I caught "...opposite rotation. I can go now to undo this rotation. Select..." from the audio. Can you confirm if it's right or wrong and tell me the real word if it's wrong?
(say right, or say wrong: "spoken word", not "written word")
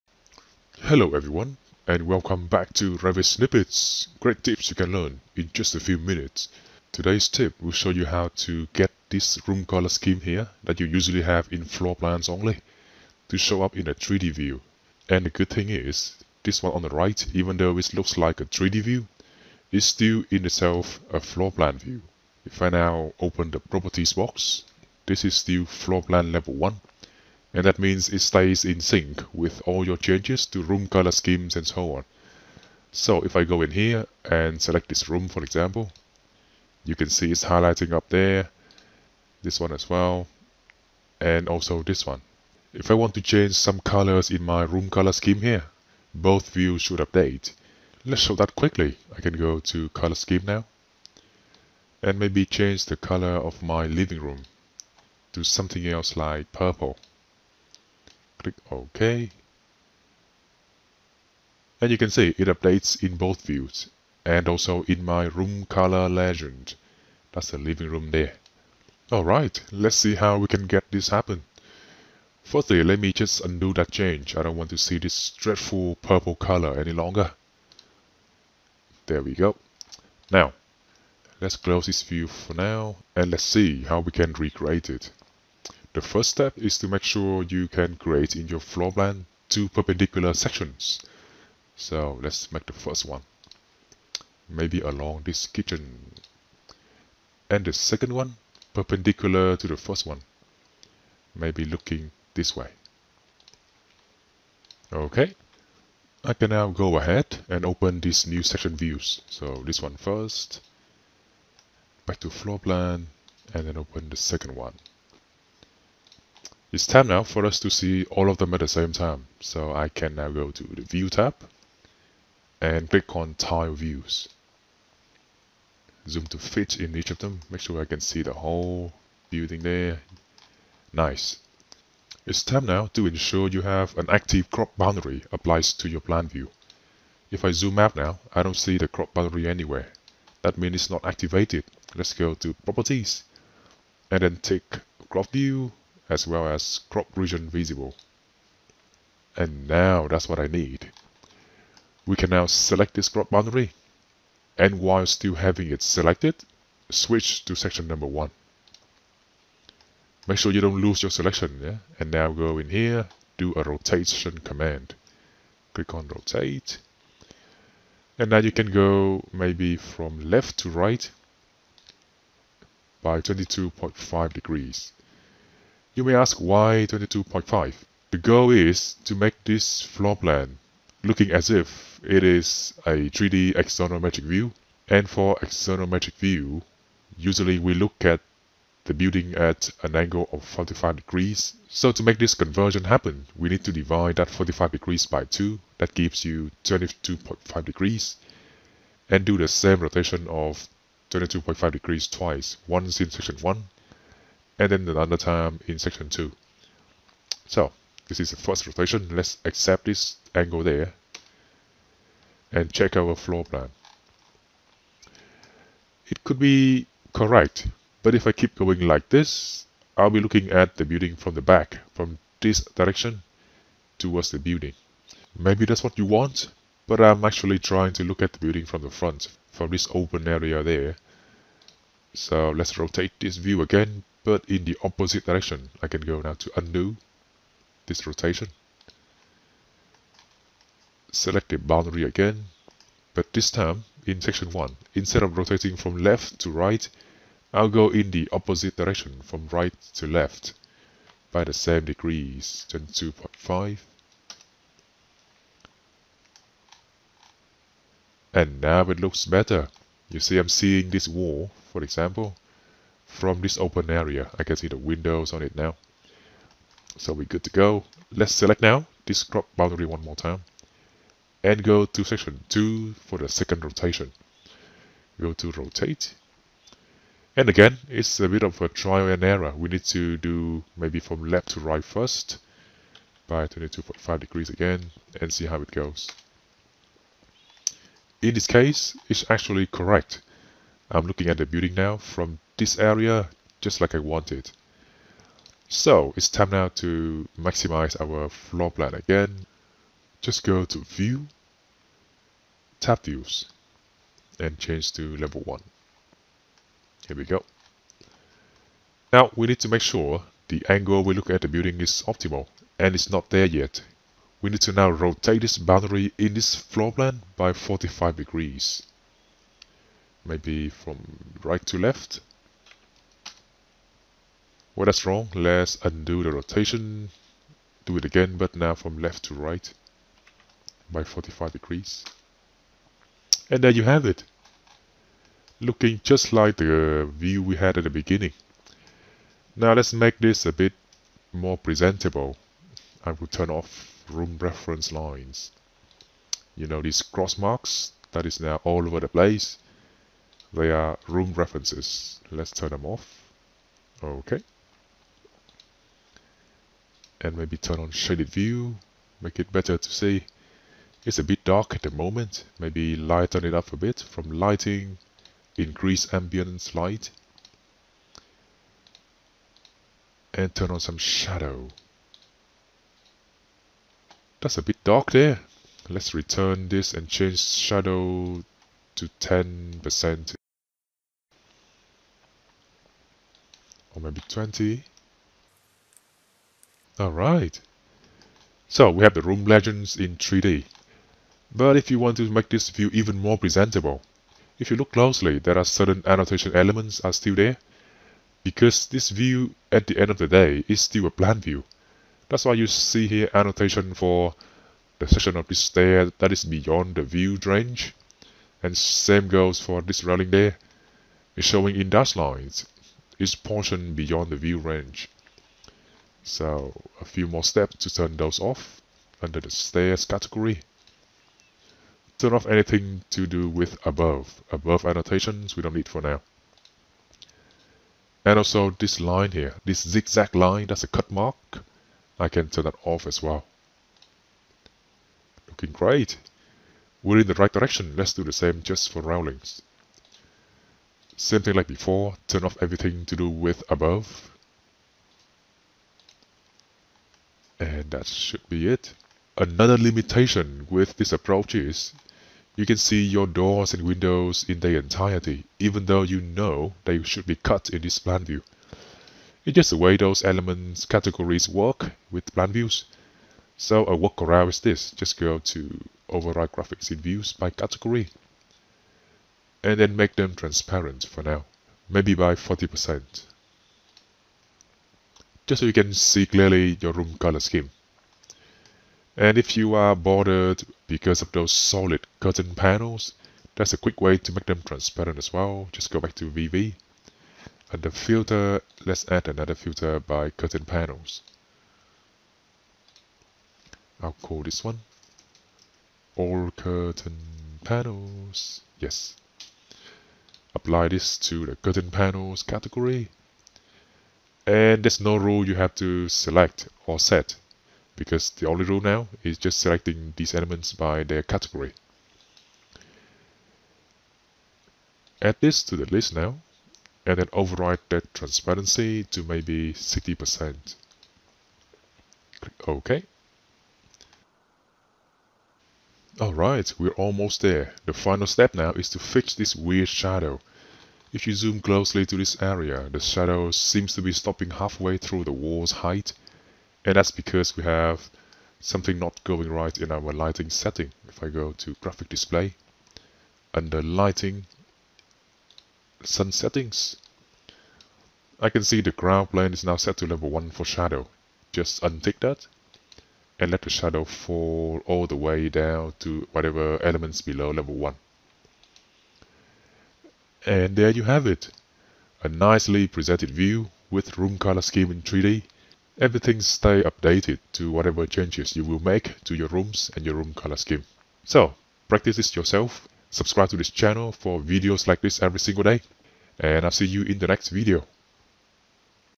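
wrong: "direction", not "rotation".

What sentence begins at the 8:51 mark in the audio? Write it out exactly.
If you zoom closely to this area, the shadow seems to be stopping halfway through the wall's height.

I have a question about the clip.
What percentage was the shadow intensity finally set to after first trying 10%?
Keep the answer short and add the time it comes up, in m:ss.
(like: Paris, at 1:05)
20%, at 6:24.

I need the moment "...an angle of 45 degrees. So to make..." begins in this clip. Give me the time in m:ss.
3:09.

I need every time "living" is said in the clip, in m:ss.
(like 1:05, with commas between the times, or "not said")
0:53, 1:07.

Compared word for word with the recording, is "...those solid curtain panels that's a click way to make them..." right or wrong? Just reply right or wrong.
wrong.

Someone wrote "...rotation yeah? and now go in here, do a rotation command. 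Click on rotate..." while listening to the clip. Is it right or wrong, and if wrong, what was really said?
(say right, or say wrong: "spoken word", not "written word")
wrong: "selection", not "rotation".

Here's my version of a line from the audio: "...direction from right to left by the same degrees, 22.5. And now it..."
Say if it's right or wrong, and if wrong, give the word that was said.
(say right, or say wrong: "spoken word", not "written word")
right.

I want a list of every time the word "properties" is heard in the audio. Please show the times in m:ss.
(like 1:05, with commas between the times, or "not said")
0:23, 2:22.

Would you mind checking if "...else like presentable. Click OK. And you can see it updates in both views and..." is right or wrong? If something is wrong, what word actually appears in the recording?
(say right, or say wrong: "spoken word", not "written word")
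wrong: "purple", not "presentable".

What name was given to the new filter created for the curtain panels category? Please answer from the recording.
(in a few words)
All curtain panels.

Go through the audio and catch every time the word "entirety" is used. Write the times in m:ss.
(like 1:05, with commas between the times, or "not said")
7:34.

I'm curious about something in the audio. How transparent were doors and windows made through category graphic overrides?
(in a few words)
40%.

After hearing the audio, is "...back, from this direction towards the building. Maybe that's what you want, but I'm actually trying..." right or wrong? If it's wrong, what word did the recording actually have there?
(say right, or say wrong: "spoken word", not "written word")
right.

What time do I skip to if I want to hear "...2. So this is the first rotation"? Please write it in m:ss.
3:26.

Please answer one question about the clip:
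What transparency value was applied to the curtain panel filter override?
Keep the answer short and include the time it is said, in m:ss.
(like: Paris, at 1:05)
60%, at 8:39.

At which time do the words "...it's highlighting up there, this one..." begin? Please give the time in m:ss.
0:37.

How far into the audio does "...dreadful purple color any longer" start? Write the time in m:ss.
1:15.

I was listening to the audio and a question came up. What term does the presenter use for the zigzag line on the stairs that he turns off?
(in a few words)
Cut mark.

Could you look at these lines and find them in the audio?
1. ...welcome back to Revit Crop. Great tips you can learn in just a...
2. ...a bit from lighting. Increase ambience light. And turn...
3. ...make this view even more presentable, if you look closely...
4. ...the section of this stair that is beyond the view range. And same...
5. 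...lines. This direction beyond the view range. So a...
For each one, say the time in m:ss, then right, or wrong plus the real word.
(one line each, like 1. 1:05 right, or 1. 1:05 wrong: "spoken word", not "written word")
1. 0:02 wrong: "Snippets", not "Crop"
2. 6:03 right
3. 6:32 right
4. 6:44 right
5. 6:52 wrong: "portion", not "direction".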